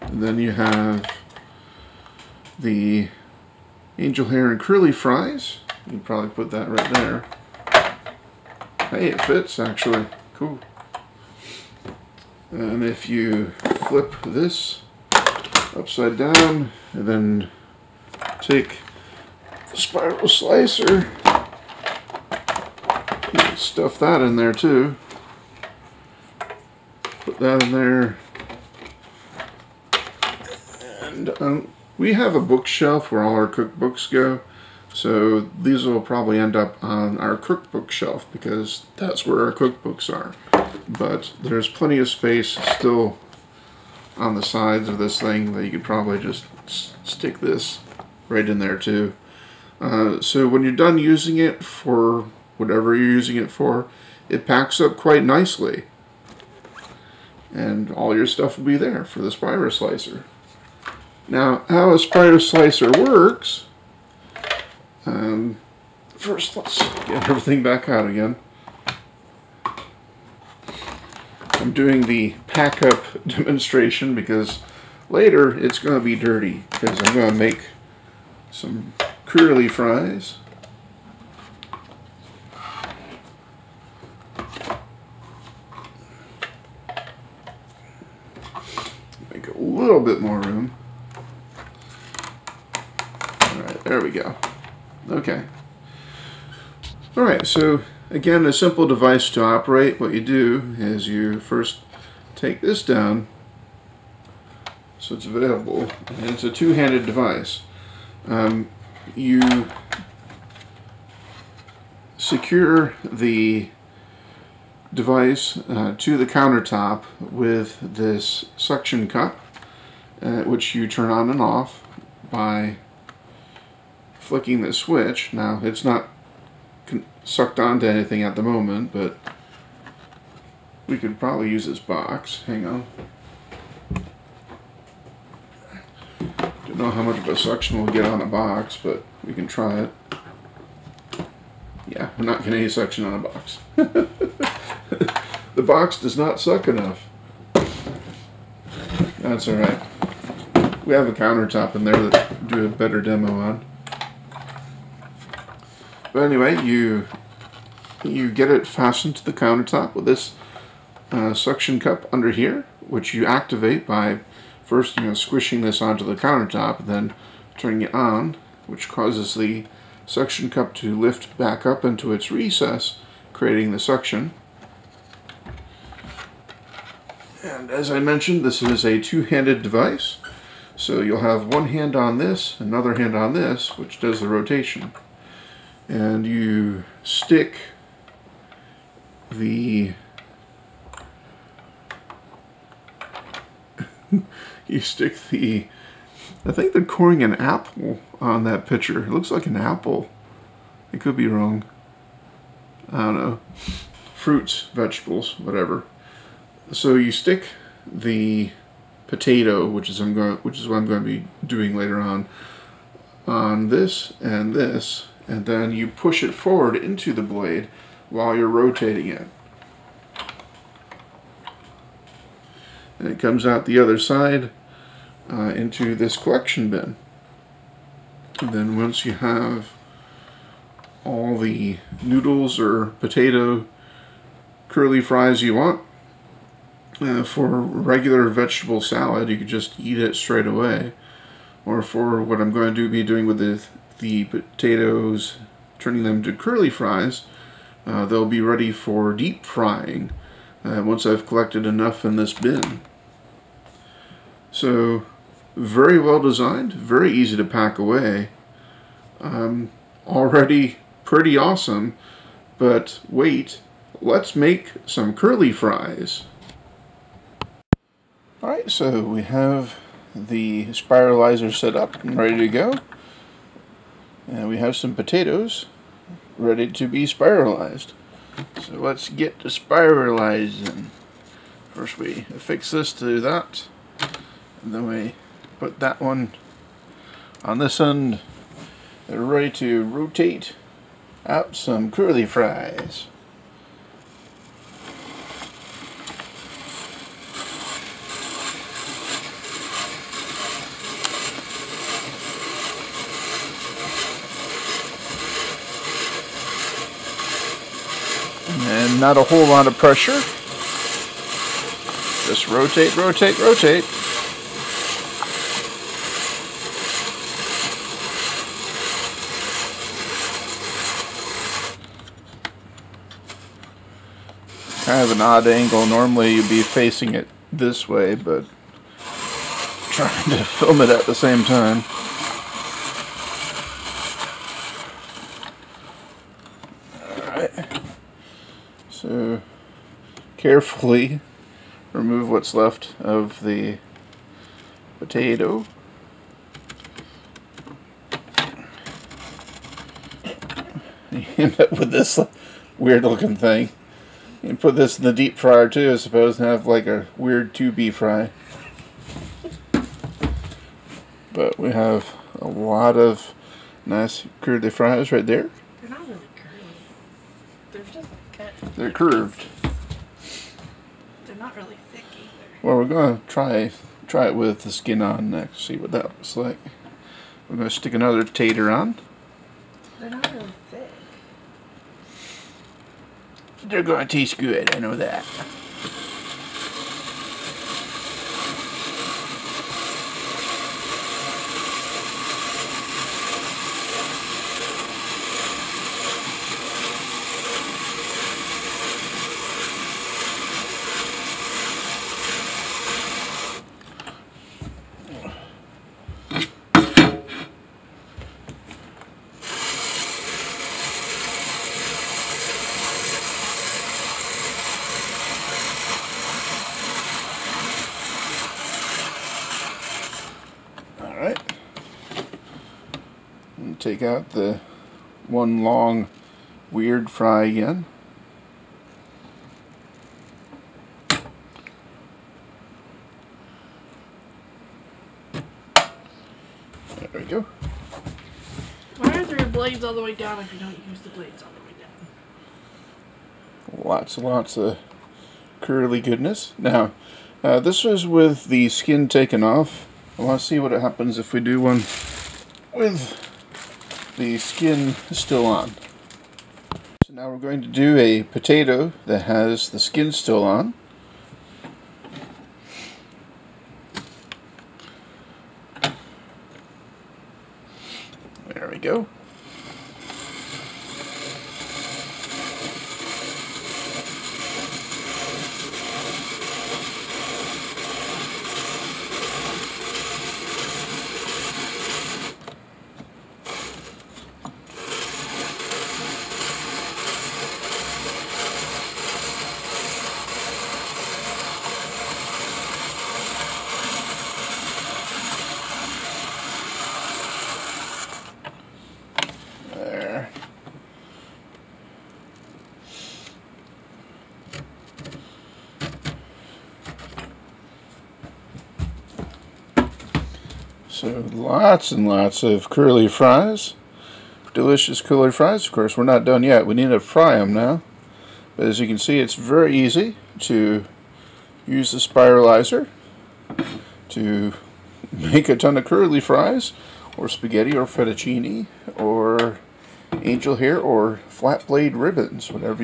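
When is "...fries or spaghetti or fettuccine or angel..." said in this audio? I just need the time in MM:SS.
08:46.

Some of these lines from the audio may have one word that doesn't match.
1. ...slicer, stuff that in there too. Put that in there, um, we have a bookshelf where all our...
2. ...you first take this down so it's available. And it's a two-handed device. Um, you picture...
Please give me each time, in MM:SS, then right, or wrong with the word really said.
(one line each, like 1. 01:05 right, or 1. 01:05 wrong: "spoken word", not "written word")
1. 00:20 right
2. 01:41 wrong: "secure", not "picture".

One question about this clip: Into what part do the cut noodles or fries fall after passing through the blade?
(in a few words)
collection bin.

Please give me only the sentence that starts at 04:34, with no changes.
And we have some potatoes ready to be spiralized.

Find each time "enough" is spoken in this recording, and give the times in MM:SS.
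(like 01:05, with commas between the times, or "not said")
02:26, 04:11.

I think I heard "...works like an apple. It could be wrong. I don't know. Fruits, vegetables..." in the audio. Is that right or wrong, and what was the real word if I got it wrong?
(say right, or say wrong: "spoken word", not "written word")
wrong: "looks", not "works".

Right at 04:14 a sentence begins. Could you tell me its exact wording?
So very well designed, very easy to pack away, um, already pretty awesome, but wait, let's make some curly fries.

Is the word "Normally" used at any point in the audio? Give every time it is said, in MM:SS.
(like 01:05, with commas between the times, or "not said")
05:25.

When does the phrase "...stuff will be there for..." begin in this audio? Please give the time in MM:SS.
00:58.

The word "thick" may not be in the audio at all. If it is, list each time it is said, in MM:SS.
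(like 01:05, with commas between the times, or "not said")
06:11, 06:20.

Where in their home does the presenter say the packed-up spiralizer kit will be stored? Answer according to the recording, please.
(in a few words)
cookbook shelf.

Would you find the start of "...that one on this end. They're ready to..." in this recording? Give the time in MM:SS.
04:45.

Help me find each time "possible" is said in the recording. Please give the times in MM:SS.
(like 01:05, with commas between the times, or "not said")
not said.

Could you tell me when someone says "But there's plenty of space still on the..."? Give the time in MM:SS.
00:40.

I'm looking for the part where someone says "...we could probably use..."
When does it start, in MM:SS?
02:10.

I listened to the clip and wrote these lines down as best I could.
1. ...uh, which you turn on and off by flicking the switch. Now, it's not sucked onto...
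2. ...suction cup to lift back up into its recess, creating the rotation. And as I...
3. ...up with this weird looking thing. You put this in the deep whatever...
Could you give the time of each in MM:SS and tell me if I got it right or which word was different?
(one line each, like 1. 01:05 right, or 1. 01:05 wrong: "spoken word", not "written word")
1. 02:00 right
2. 02:50 wrong: "suction", not "rotation"
3. 05:51 wrong: "fryer", not "whatever".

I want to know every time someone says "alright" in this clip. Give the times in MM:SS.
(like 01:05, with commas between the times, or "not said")
01:37, 02:29, 04:28, 05:37.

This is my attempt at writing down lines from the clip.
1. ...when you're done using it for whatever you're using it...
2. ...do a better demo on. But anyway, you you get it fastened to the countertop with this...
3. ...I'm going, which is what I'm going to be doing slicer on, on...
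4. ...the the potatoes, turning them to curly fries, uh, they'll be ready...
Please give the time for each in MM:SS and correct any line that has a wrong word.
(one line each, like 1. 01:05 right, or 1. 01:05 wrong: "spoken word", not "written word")
1. 00:50 right
2. 02:32 right
3. 03:29 wrong: "later", not "slicer"
4. 04:03 right.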